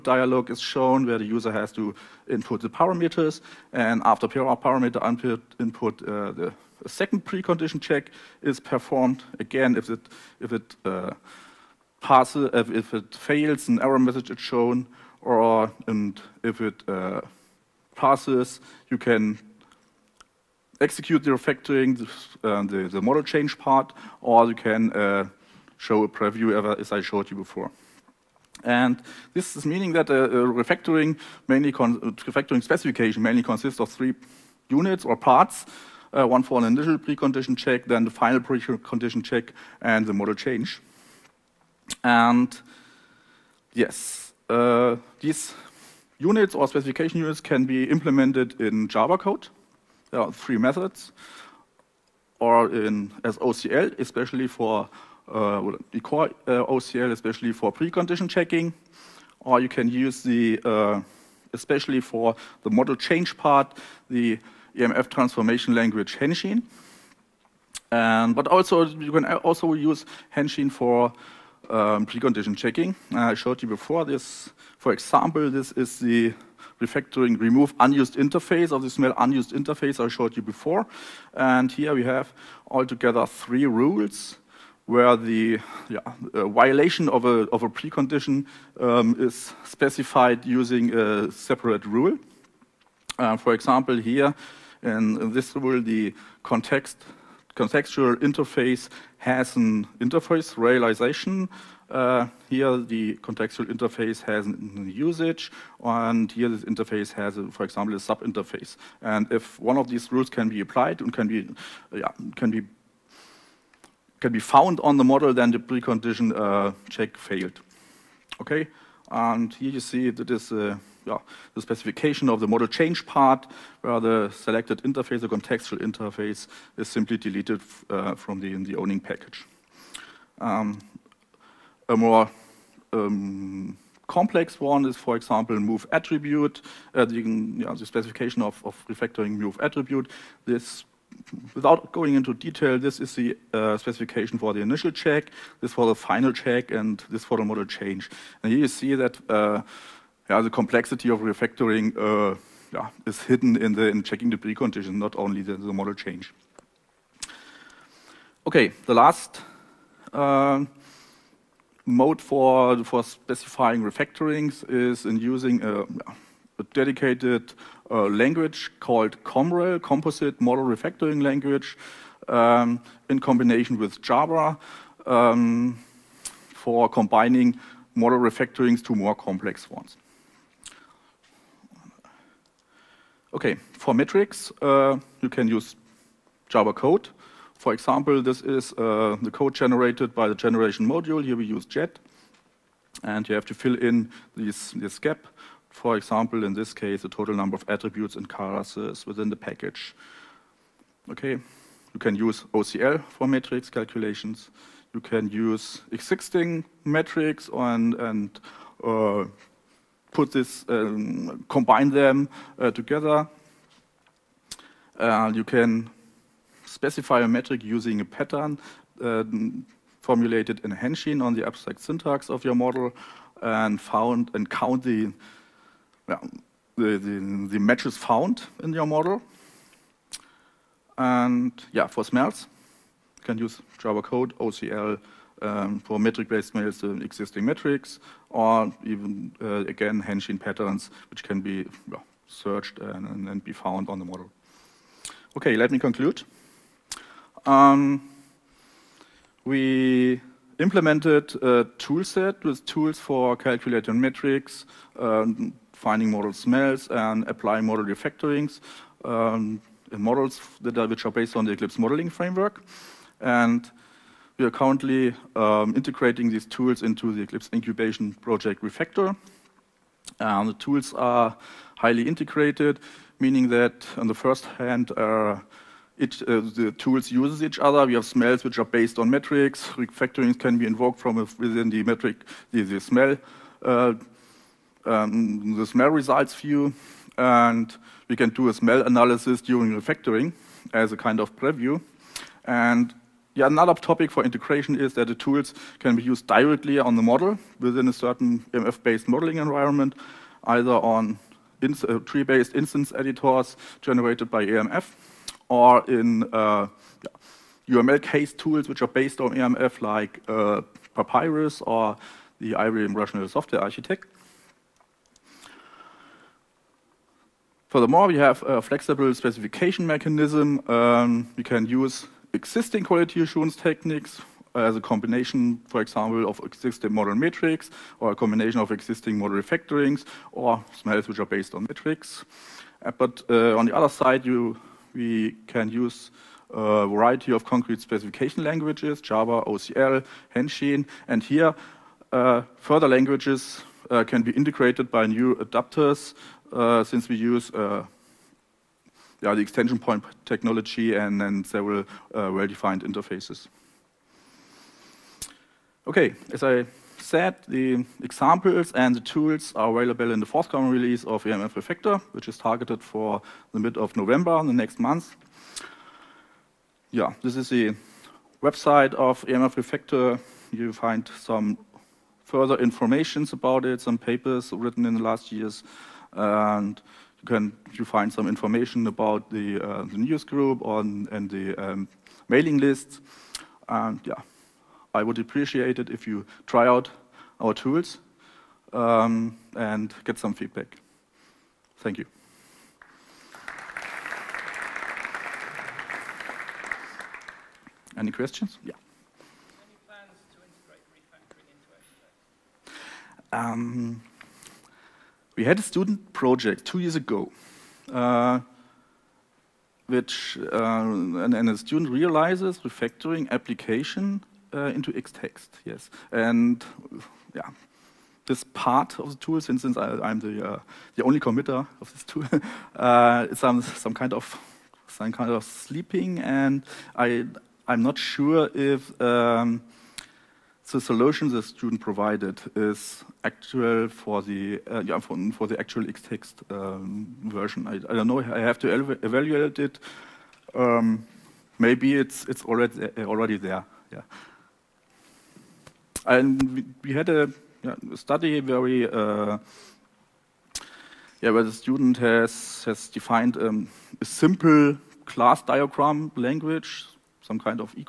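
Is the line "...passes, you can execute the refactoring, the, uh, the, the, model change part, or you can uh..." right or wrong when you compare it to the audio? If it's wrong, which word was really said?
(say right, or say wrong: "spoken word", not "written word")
right.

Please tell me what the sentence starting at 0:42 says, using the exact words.
And yes, uh, these units or specification units can be implemented in Java code.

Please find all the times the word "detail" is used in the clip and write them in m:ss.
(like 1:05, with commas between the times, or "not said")
2:22.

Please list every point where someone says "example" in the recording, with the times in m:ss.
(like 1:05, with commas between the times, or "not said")
1:14, 1:33, 1:47, 2:15, 3:07, 3:15, 5:25, 5:58.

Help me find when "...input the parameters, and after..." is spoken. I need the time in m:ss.
0:02.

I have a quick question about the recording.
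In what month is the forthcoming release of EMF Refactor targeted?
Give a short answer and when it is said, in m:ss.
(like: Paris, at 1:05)
November, at 6:03.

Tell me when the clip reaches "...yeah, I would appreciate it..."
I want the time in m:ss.
6:24.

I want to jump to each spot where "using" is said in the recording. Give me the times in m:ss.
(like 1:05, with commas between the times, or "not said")
1:30, 2:45, 3:37.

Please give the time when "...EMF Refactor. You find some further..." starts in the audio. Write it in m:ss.
6:09.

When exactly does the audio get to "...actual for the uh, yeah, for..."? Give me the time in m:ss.
7:13.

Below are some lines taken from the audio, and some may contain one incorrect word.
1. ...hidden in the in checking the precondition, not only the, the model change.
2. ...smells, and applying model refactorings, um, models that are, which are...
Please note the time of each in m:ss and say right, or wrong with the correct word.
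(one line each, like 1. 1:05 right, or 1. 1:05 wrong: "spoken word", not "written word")
1. 2:33 right
2. 4:16 right.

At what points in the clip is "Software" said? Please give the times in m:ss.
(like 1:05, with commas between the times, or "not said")
5:13.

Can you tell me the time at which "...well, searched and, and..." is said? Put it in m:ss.
4:01.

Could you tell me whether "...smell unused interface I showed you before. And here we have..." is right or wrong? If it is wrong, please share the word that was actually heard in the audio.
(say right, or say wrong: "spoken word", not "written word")
right.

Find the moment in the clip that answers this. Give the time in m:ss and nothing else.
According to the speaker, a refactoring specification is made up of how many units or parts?
0:33.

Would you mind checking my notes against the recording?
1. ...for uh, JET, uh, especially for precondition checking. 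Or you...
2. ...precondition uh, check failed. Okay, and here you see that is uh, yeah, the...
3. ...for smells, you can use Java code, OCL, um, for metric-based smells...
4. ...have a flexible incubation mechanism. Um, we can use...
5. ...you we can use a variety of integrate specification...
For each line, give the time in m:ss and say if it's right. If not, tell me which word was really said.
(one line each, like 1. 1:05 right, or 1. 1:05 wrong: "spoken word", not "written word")
1. 0:54 wrong: "OCL", not "JET"
2. 1:55 right
3. 3:51 right
4. 5:18 wrong: "specification", not "incubation"
5. 5:34 wrong: "concrete", not "integrate".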